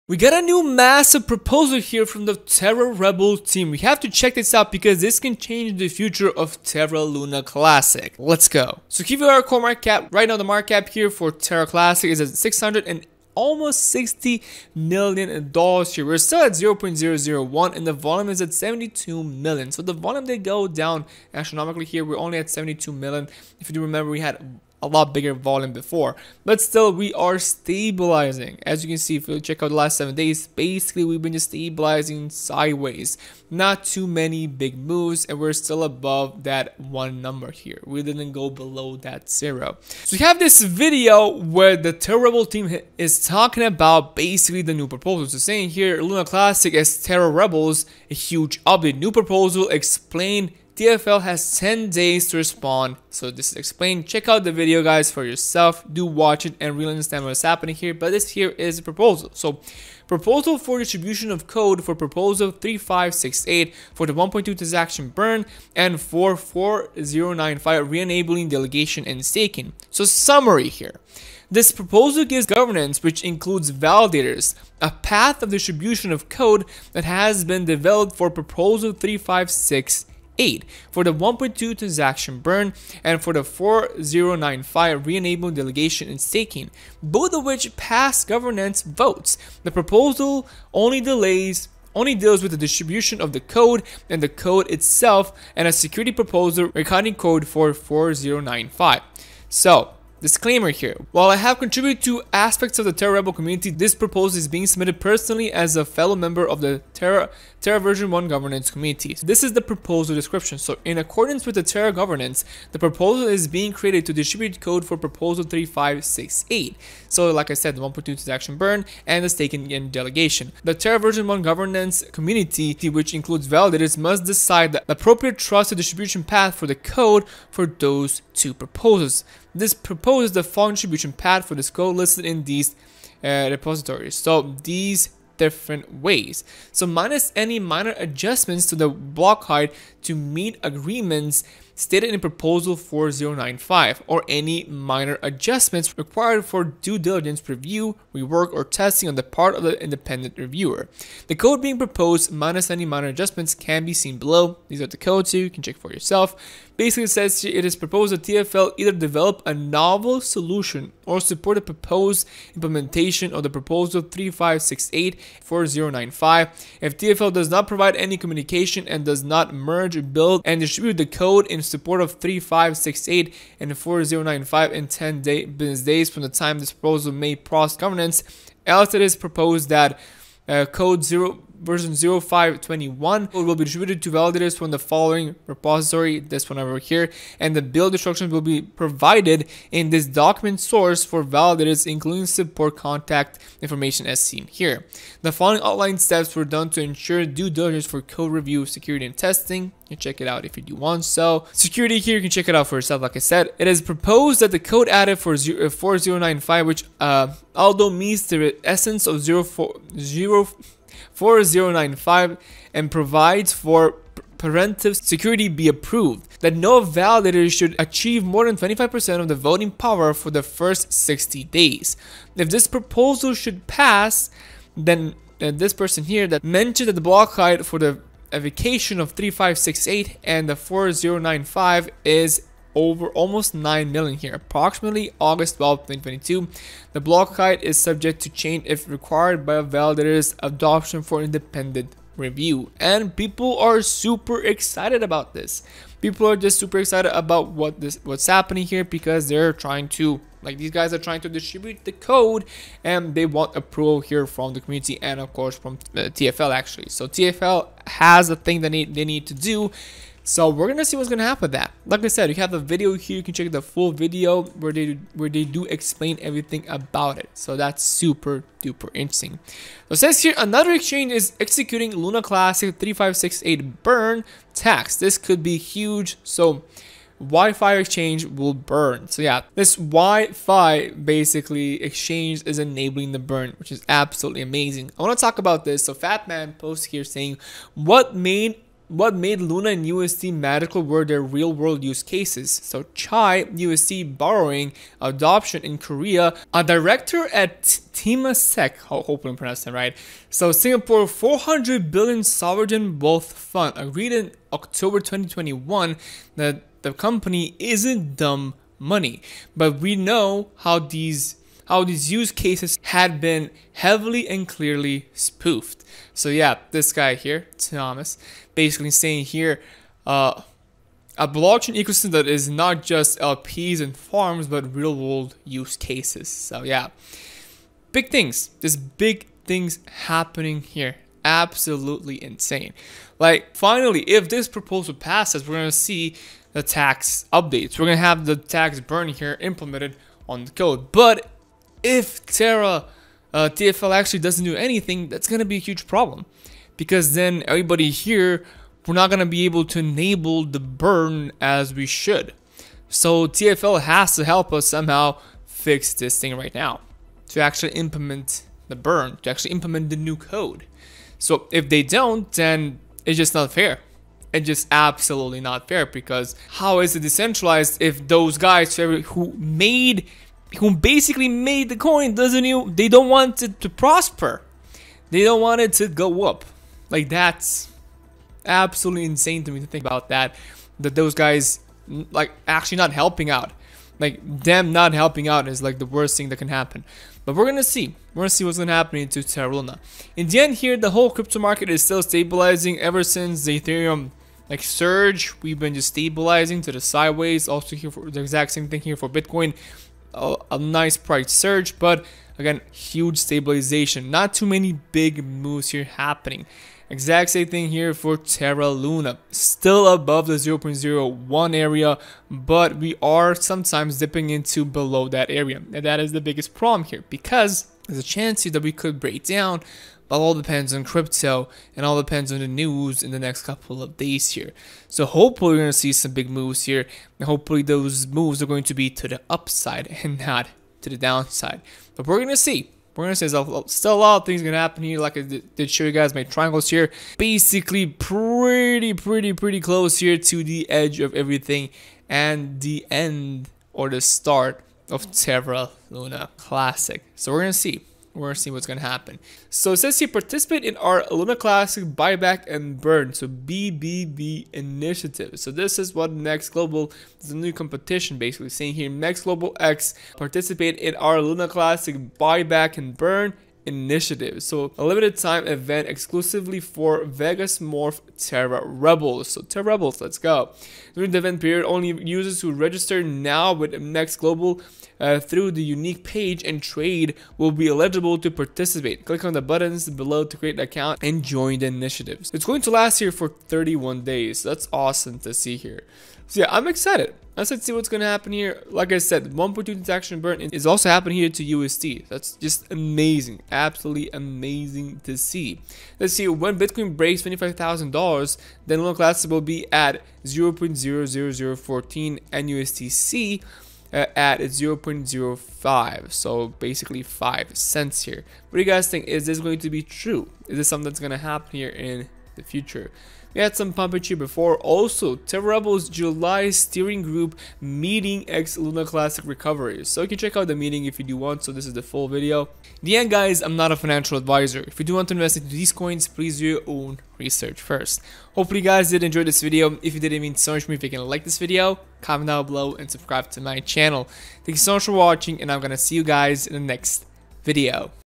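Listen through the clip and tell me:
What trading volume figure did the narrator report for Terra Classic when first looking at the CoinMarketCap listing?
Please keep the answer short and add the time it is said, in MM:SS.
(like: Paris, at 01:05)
72 million, at 00:17.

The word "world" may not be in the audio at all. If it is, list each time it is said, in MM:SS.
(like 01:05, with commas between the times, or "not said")
04:51, 05:24.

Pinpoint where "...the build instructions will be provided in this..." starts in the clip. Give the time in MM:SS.
03:07.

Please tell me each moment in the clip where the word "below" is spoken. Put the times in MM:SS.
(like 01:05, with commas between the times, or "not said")
00:38, 02:34, 06:54, 07:59, 08:52.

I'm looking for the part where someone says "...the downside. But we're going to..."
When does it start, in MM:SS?
07:10.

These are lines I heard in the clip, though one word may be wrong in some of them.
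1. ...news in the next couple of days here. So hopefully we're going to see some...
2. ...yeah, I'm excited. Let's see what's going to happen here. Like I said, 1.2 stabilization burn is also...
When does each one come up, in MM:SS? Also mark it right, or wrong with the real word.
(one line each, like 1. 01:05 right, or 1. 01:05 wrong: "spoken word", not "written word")
1. 07:02 right
2. 08:06 wrong: "transaction", not "stabilization".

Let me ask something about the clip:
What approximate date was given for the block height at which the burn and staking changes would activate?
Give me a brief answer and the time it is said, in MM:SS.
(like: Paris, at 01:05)
August 12, 2022, at 03:55.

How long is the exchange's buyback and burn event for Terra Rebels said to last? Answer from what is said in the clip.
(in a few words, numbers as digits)
31 days.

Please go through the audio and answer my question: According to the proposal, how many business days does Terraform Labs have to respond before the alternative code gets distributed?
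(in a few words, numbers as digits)
10.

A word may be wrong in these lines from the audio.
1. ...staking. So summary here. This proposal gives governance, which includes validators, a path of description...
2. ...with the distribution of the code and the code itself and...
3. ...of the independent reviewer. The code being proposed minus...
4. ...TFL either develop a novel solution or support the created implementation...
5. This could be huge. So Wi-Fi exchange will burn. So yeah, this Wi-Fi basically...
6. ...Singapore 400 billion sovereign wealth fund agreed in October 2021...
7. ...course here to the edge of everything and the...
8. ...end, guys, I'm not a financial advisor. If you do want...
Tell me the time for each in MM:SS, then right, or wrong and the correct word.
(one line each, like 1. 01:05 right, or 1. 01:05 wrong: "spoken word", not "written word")
1. 01:09 wrong: "distribution", not "description"
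2. 01:32 right
3. 02:29 right
4. 02:38 wrong: "proposed", not "created"
5. 04:34 right
6. 05:00 right
7. 07:19 wrong: "close", not "course"
8. 08:42 right.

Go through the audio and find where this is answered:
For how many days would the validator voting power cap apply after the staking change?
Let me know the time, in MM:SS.
03:40.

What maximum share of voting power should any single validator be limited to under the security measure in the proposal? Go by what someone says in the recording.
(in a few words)
25%.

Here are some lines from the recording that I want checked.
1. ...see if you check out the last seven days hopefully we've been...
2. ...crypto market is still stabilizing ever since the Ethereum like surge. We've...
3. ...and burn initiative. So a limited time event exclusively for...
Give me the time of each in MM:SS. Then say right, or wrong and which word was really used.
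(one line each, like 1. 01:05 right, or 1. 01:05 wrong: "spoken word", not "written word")
1. 00:28 wrong: "basically", not "hopefully"
2. 06:31 right
3. 07:42 right.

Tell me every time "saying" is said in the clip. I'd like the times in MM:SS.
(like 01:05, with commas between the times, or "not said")
00:45, 04:47, 05:18, 07:38.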